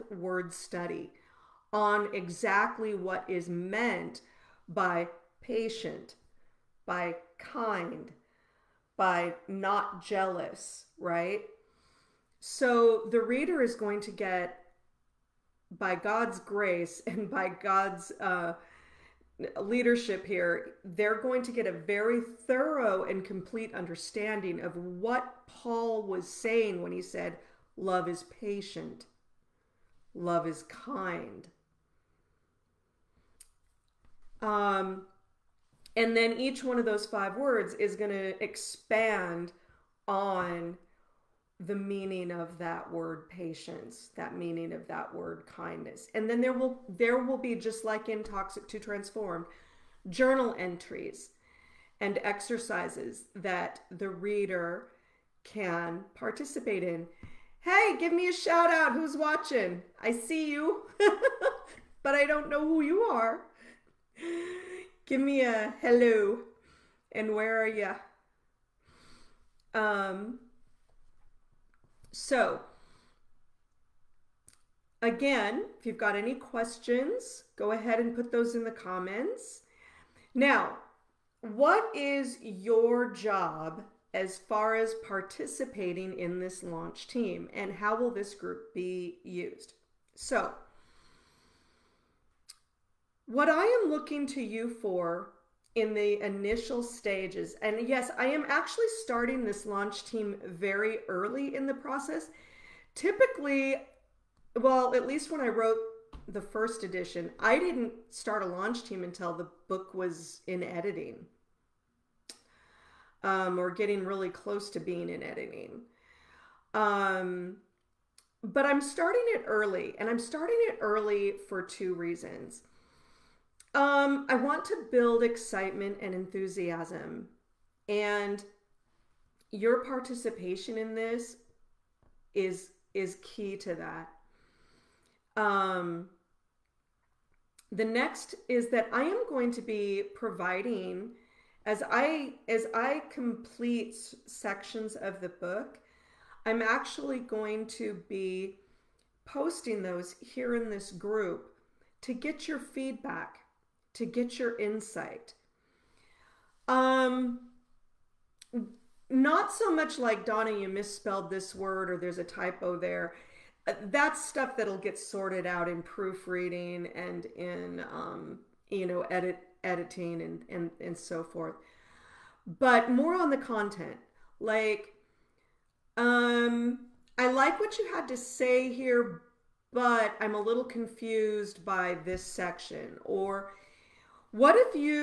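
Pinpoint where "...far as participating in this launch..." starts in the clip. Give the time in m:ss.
1:24.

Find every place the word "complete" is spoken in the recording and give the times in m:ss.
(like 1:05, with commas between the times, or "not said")
0:23, 2:23.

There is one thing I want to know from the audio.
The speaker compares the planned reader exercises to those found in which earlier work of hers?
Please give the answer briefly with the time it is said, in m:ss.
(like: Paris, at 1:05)
Toxic to Transform, at 0:48.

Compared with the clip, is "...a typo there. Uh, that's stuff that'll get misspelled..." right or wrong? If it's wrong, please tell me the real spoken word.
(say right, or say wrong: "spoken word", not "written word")
wrong: "sorted", not "misspelled".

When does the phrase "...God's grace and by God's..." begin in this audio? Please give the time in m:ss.
0:15.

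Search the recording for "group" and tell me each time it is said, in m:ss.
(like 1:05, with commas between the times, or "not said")
1:28, 2:30.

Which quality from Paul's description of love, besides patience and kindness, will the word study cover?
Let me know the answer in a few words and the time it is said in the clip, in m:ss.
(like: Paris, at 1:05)
not jealous, at 0:09.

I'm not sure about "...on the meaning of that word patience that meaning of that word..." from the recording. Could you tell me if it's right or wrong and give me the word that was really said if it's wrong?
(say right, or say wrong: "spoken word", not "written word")
right.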